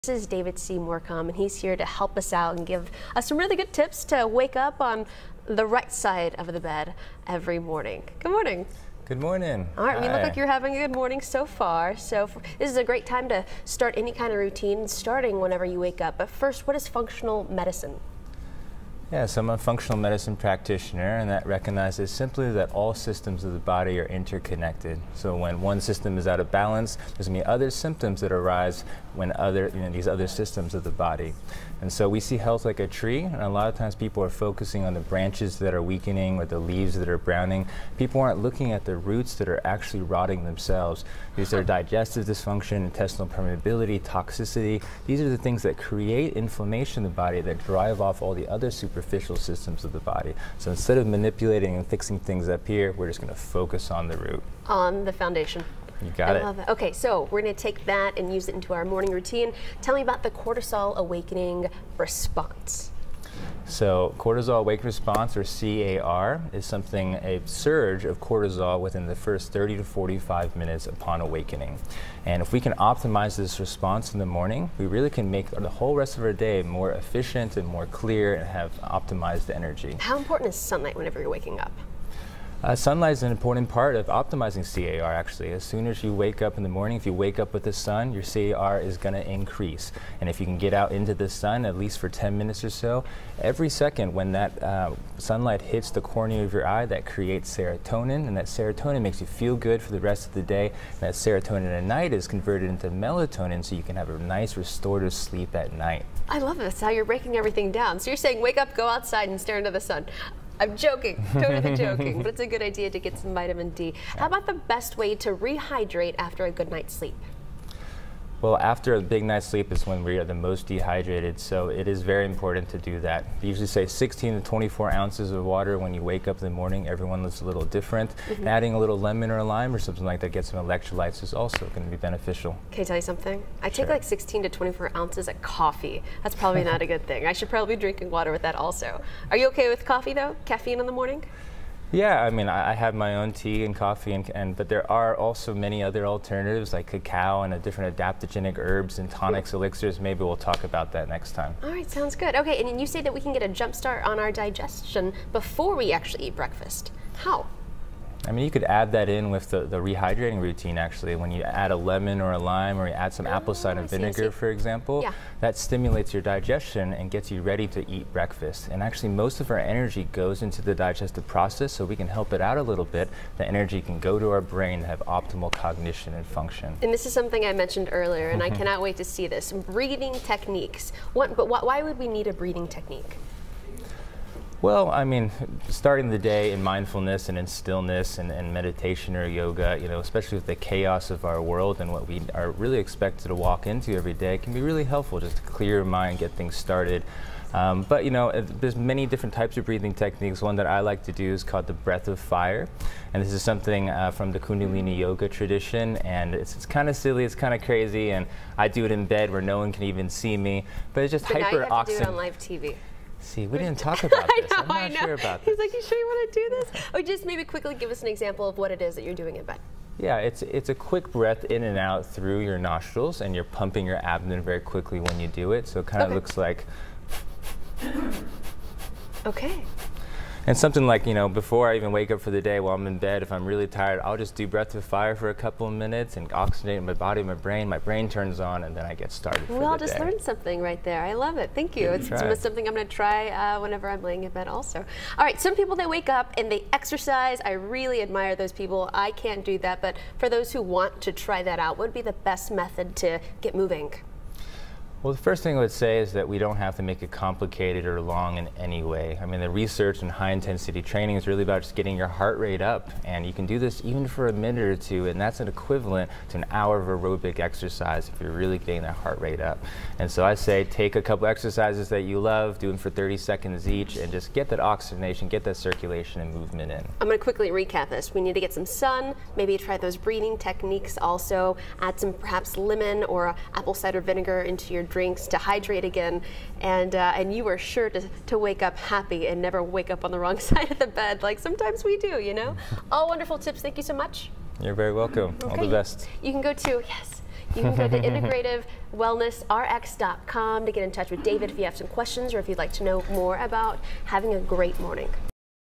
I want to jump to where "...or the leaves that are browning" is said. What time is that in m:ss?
0:36.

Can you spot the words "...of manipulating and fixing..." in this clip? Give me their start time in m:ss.
0:50.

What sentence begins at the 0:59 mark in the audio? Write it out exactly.
Tell me about the cortisol awakening response.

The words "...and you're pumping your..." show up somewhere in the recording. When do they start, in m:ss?
3:43.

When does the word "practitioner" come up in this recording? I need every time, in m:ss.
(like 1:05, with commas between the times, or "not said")
0:20.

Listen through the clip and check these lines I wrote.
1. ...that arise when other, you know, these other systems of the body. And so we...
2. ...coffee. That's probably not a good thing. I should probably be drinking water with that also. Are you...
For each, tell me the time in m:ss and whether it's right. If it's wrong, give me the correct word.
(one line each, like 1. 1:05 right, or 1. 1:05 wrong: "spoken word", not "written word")
1. 0:28 right
2. 2:15 right.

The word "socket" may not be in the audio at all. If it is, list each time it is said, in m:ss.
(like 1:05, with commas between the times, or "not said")
not said.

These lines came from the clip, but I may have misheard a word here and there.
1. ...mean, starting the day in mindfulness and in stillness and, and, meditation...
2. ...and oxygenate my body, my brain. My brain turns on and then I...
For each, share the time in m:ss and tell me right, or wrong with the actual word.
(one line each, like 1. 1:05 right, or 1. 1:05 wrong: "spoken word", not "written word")
1. 3:05 right
2. 3:56 right.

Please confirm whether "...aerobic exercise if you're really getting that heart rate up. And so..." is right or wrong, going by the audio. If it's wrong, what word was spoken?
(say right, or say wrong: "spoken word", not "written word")
right.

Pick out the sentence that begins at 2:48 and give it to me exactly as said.
And actually, most of our energy goes into the digestive process, so we can help it out a little bit.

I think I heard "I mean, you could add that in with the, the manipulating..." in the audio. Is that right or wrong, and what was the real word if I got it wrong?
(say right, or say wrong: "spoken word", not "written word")
wrong: "rehydrating", not "manipulating".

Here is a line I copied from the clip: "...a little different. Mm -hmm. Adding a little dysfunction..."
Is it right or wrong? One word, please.
wrong.